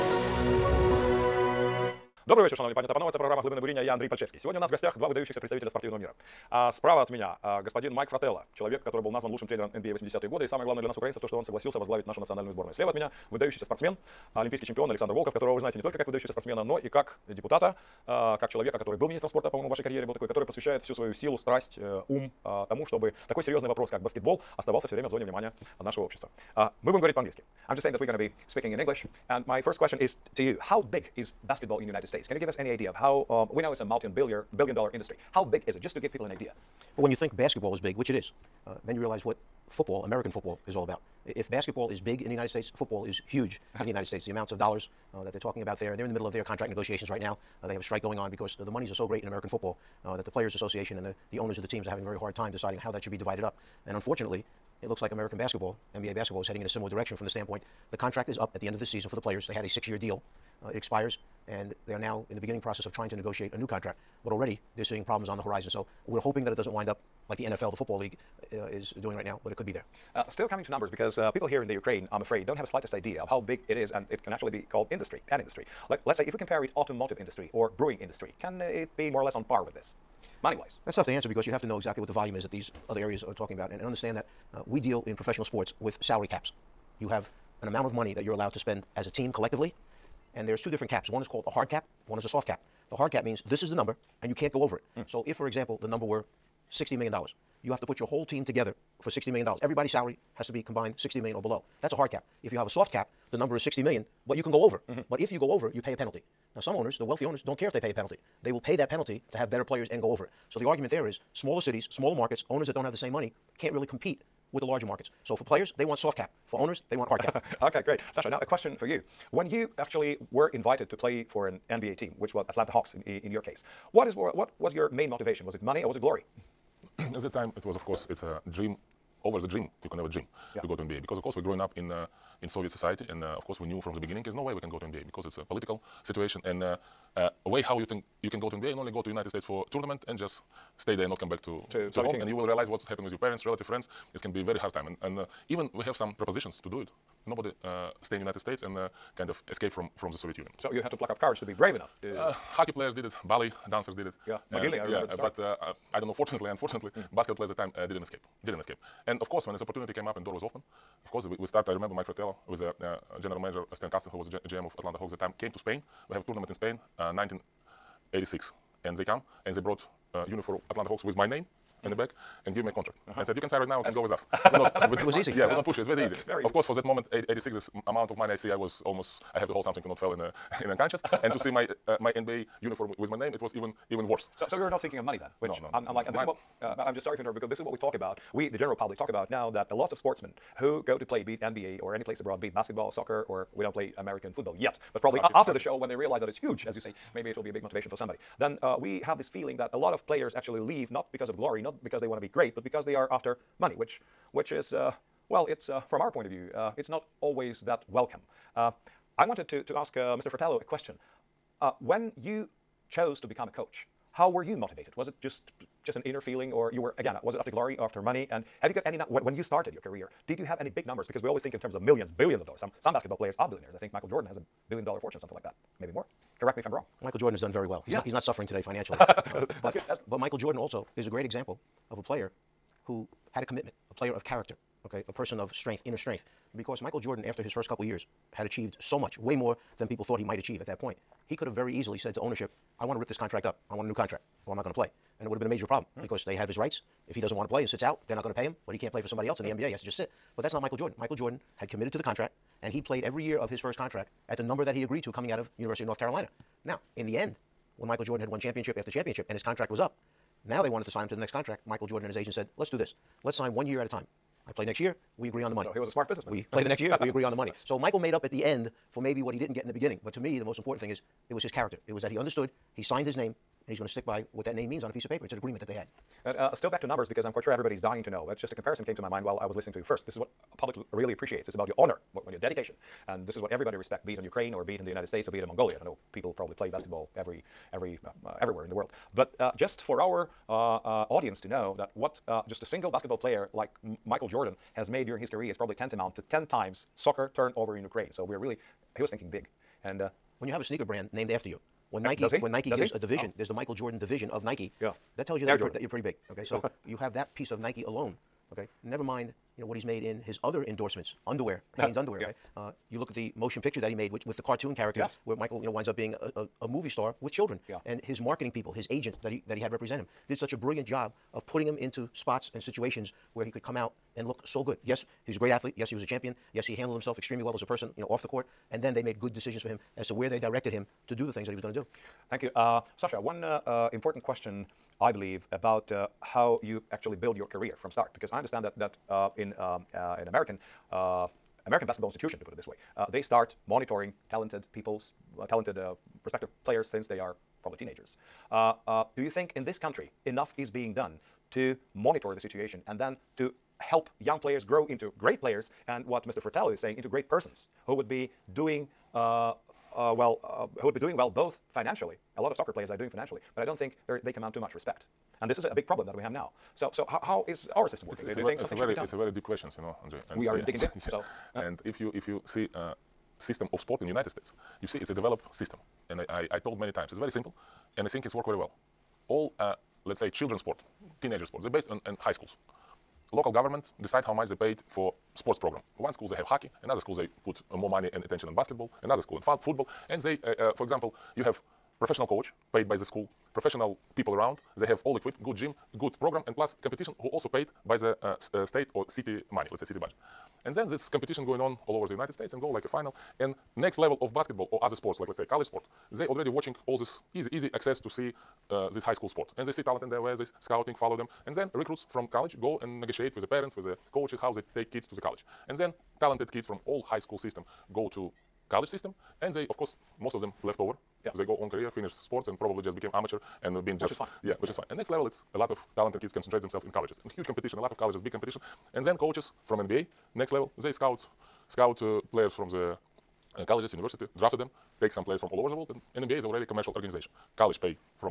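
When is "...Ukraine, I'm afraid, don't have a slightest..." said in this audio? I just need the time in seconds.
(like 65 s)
71 s.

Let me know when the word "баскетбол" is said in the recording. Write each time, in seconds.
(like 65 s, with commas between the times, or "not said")
23 s.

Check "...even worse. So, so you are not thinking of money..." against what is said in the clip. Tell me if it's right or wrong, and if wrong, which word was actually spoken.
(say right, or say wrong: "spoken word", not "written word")
right.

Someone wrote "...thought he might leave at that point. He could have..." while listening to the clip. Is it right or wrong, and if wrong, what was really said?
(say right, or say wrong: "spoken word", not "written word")
wrong: "achieve", not "leave".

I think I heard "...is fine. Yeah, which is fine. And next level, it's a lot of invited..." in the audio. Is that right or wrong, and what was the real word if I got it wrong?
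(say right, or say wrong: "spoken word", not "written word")
wrong: "talented", not "invited".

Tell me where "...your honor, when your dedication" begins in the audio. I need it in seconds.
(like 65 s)
281 s.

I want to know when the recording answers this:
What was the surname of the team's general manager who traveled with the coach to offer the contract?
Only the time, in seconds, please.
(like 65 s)
163 s.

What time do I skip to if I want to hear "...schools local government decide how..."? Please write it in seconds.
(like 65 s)
382 s.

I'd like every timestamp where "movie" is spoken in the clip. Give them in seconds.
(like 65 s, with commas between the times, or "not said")
316 s.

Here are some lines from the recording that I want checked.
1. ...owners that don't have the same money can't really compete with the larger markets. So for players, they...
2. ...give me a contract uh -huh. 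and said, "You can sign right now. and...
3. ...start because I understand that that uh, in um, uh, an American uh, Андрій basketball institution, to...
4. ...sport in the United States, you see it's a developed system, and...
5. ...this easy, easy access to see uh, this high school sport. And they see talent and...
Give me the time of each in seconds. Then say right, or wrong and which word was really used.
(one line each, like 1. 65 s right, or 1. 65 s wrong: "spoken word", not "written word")
1. 112 s right
2. 172 s right
3. 337 s wrong: "American", not "Андрій"
4. 373 s right
5. 406 s right.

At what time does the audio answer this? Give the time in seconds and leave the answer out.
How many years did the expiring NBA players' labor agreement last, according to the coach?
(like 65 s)
59 s.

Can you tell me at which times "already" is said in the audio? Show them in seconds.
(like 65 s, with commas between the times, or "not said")
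64 s, 406 s, 436 s.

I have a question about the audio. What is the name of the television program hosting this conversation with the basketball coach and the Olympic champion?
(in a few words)
Глибини буріння.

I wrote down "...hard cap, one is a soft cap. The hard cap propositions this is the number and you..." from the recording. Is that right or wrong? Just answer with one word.
wrong.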